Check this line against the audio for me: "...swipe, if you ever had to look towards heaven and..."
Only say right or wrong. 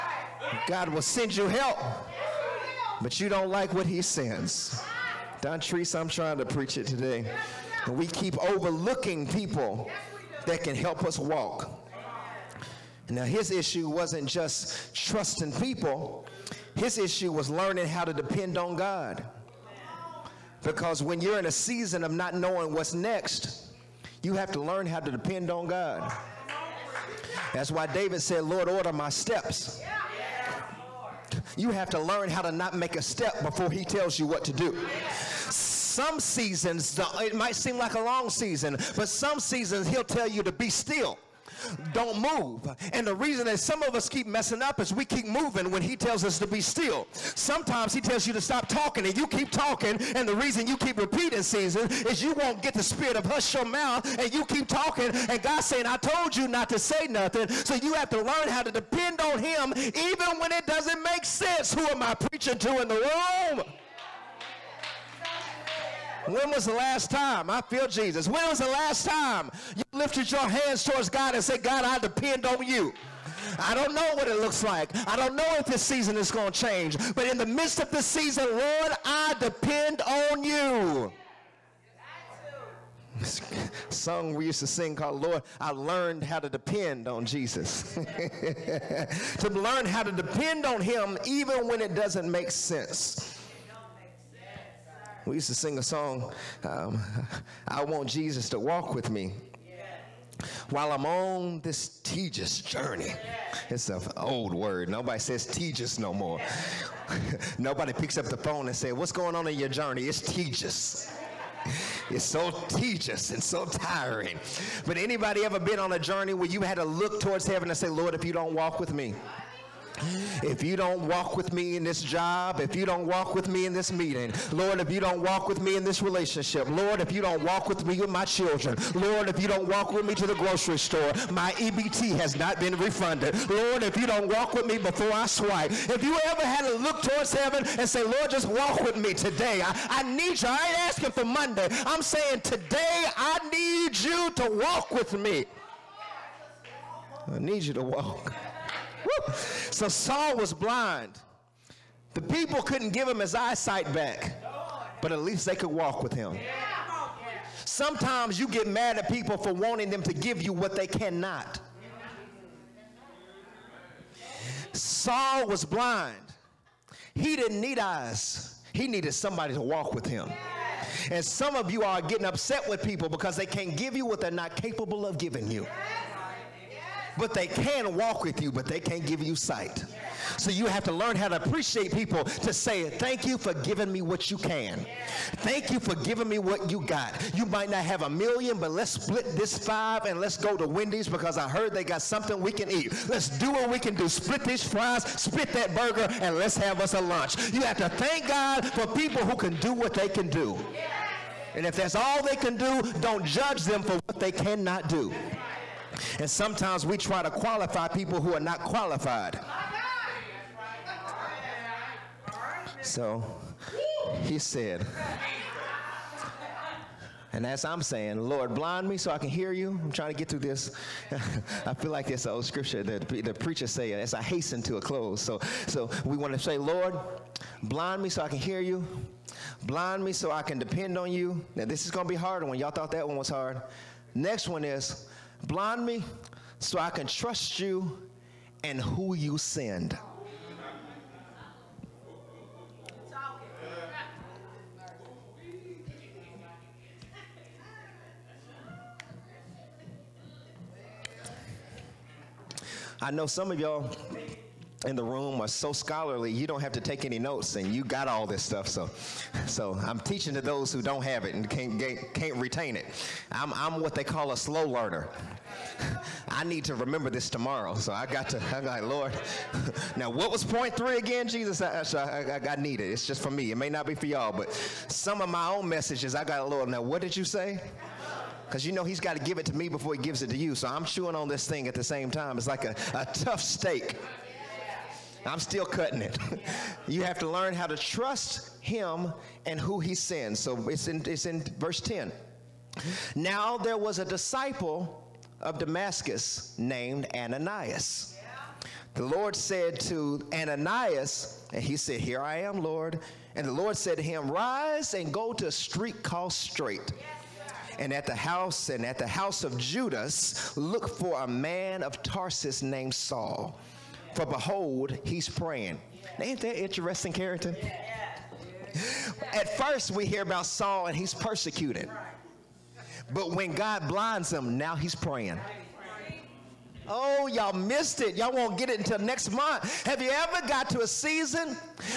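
right.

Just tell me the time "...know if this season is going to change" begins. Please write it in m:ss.
1:15.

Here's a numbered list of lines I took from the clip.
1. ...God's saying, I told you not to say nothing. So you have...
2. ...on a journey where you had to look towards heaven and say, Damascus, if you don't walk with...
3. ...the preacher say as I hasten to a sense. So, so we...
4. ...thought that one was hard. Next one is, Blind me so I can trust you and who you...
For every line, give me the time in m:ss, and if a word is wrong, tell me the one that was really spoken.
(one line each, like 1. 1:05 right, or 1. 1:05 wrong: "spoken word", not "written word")
1. 0:55 right
2. 1:55 wrong: "Lord", not "Damascus"
3. 3:43 wrong: "close", not "sense"
4. 3:52 right.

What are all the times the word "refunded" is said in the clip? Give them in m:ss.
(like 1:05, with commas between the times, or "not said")
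2:12.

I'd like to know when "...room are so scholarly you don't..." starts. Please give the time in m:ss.
4:15.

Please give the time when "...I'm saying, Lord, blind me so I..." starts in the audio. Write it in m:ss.
3:37.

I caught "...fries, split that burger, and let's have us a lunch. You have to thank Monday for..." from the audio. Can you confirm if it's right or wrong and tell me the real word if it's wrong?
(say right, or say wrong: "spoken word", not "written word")
wrong: "God", not "Monday".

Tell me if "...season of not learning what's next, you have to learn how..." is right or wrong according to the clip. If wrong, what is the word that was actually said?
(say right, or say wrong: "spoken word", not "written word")
wrong: "knowing", not "learning".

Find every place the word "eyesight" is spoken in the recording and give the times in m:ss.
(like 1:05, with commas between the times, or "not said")
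2:33.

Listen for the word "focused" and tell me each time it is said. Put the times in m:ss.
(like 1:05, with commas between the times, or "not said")
not said.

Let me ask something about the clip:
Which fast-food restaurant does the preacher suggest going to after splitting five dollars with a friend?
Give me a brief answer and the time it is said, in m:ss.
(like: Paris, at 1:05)
Wendy's, at 3:10.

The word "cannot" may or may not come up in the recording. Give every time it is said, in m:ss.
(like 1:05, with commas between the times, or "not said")
2:40, 3:24.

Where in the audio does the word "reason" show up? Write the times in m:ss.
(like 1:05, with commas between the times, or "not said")
0:43, 0:50.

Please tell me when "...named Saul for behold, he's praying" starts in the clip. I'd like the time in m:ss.
5:12.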